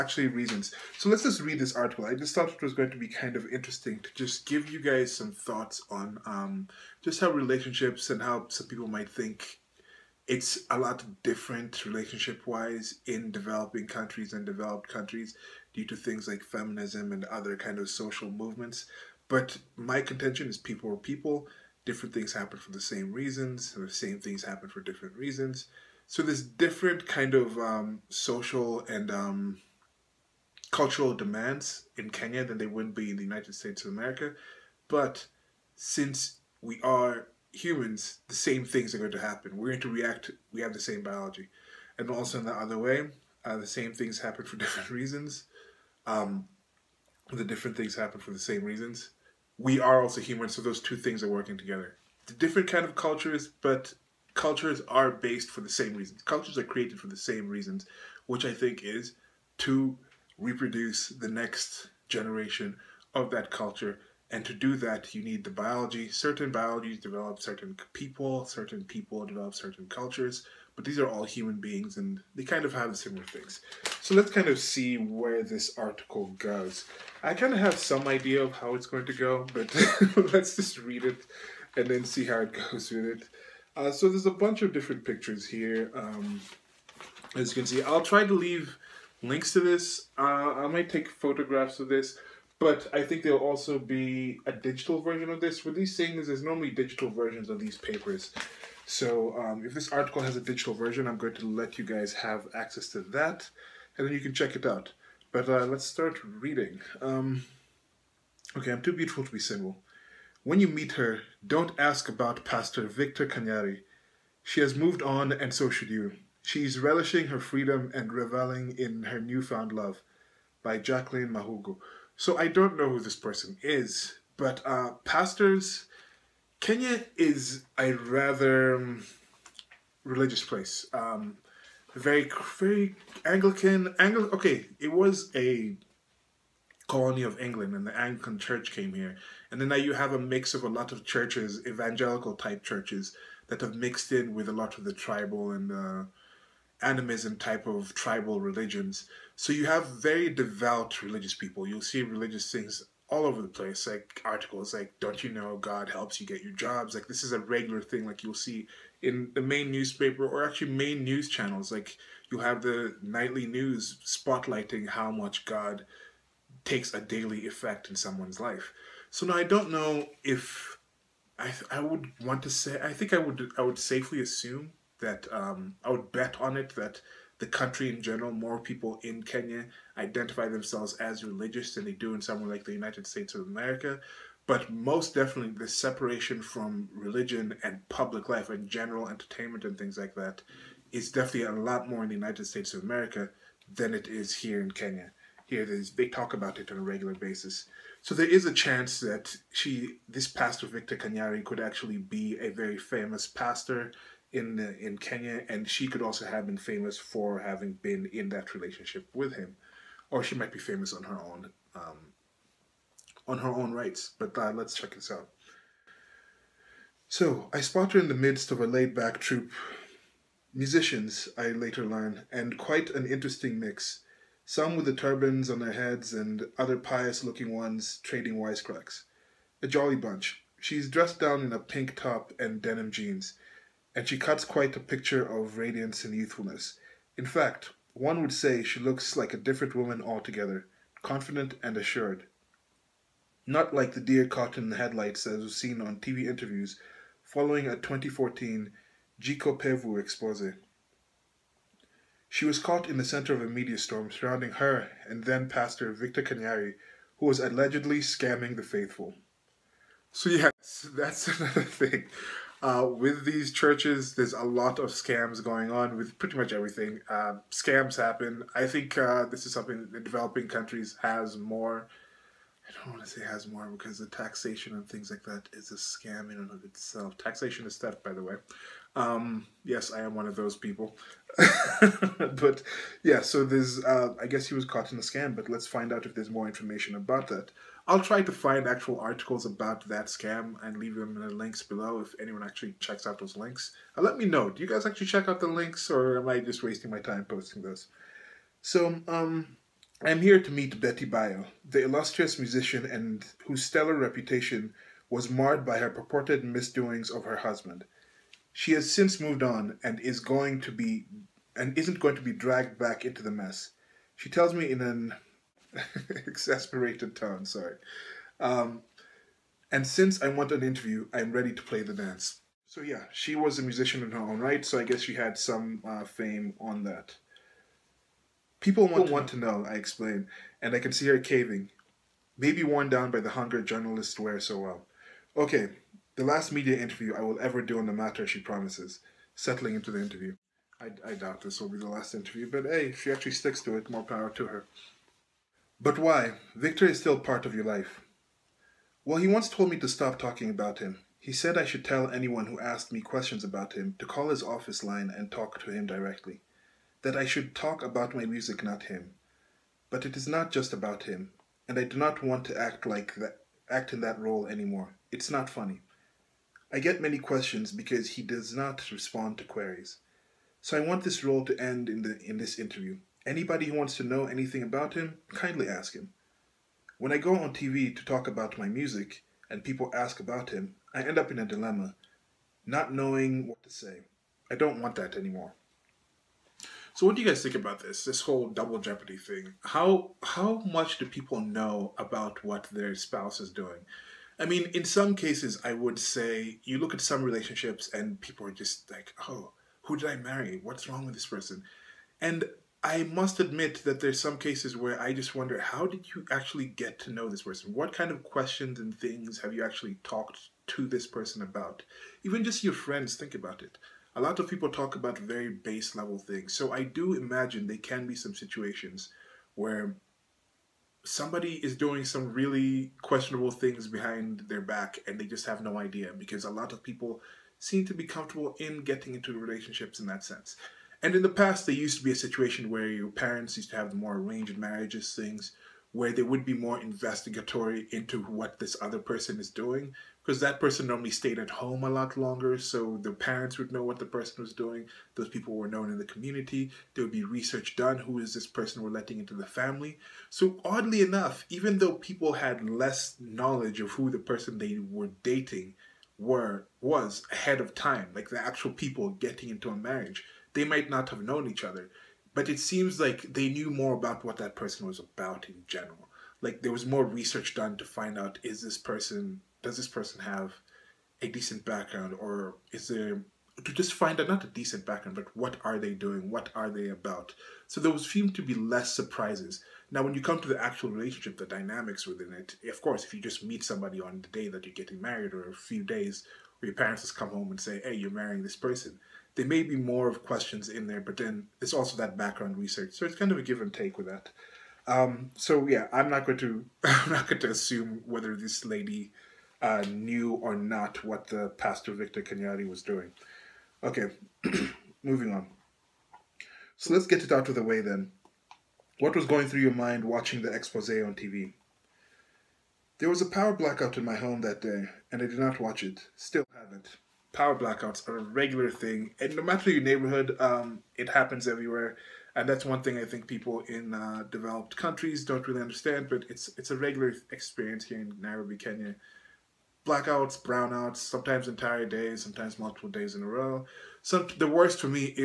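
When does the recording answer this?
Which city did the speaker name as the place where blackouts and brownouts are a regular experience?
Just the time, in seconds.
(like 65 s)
528 s.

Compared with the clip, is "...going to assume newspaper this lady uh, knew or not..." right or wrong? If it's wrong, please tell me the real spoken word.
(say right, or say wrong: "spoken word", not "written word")
wrong: "whether", not "newspaper".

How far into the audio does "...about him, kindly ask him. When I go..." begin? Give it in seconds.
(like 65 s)
374 s.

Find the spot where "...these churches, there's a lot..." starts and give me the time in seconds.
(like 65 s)
263 s.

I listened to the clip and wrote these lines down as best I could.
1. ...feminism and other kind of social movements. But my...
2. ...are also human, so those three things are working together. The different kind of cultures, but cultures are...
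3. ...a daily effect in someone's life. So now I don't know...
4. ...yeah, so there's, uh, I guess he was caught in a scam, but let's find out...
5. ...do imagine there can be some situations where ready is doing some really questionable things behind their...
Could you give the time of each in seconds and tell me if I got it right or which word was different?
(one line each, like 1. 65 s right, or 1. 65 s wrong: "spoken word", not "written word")
1. 16 s right
2. 49 s wrong: "two", not "three"
3. 166 s right
4. 283 s right
5. 416 s wrong: "somebody", not "ready".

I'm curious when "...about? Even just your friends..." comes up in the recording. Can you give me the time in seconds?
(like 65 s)
411 s.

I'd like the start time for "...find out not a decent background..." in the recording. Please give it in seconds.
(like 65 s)
473 s.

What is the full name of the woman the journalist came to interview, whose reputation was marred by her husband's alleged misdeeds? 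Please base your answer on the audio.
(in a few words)
Betty Bayo.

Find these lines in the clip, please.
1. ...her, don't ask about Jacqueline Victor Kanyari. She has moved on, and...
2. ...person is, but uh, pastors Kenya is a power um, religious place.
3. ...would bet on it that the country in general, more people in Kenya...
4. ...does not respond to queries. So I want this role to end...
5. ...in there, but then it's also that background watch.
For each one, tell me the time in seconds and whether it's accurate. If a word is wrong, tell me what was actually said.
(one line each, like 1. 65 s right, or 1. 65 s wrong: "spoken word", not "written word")
1. 110 s wrong: "Pastor", not "Jacqueline"
2. 123 s wrong: "rather", not "power"
3. 175 s right
4. 368 s right
5. 490 s wrong: "research", not "watch".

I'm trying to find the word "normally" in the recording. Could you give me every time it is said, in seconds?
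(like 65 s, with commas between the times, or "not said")
96 s, 440 s.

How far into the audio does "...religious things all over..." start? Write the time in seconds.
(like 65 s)
152 s.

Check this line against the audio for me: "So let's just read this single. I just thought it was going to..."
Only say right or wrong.
wrong.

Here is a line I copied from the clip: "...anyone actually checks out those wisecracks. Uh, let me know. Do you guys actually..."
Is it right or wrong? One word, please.
wrong.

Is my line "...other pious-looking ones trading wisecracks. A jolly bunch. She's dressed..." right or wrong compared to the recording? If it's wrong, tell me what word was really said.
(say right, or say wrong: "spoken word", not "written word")
right.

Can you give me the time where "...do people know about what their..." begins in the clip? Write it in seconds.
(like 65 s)
390 s.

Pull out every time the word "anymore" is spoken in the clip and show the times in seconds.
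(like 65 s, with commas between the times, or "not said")
364 s, 385 s.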